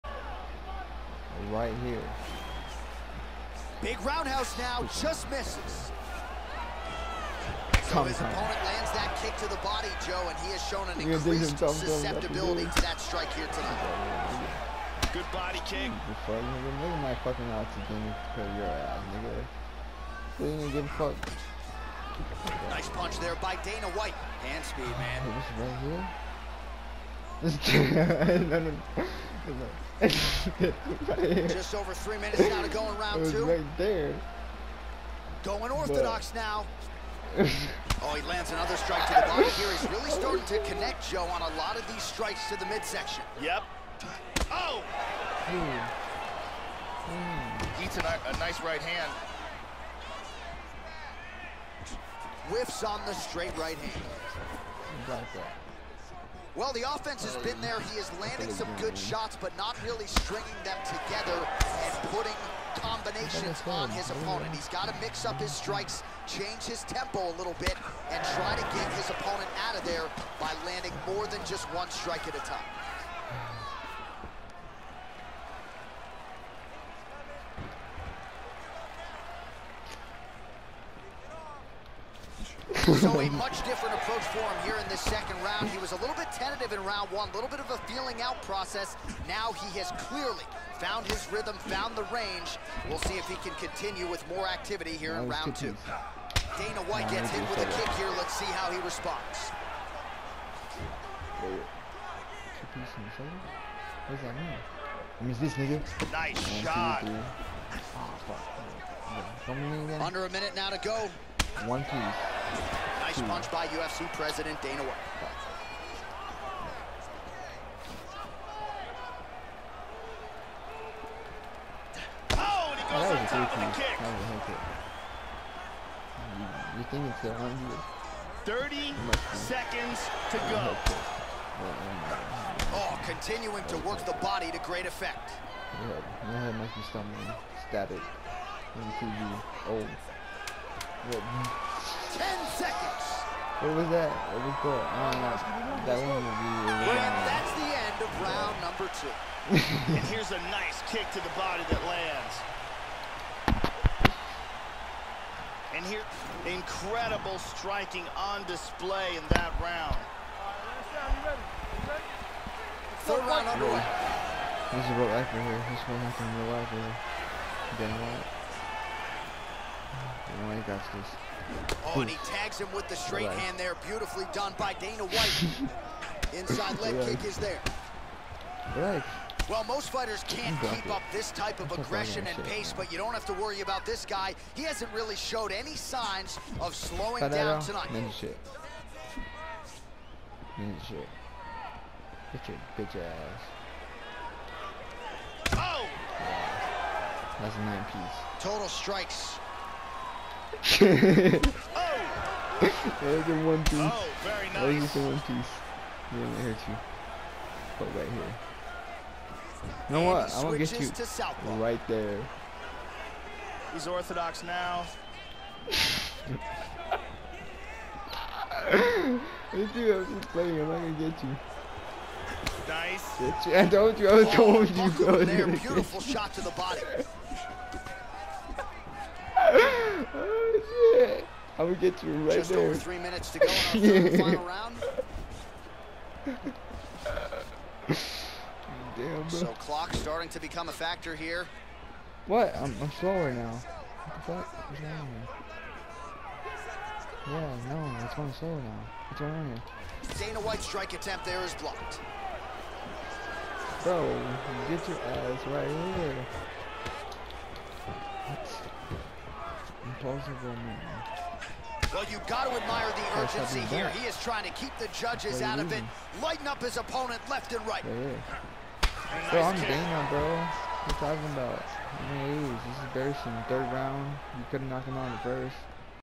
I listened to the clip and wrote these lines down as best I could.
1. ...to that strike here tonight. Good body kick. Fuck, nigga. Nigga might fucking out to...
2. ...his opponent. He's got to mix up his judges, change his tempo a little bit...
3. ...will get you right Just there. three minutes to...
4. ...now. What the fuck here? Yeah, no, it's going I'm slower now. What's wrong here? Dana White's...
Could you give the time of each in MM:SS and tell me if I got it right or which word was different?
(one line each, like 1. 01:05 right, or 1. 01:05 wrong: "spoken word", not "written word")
1. 00:12 right
2. 01:03 wrong: "strikes", not "judges"
3. 03:51 right
4. 04:03 right.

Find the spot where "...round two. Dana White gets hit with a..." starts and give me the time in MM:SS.
01:35.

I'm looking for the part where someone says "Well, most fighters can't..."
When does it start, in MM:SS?
02:59.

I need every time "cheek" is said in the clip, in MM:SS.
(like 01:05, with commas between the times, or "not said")
not said.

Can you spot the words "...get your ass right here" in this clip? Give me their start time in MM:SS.
04:14.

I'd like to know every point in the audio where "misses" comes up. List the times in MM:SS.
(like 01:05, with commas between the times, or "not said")
00:05.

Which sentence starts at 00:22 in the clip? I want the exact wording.
Nice punch there by Dana White.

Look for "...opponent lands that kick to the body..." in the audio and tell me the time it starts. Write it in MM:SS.
00:08.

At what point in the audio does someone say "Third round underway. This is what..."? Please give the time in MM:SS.
02:43.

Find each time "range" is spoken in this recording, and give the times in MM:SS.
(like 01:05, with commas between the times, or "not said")
01:32.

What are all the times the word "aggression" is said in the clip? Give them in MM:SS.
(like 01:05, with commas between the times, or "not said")
03:01.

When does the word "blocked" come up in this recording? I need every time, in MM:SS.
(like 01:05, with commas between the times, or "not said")
04:11.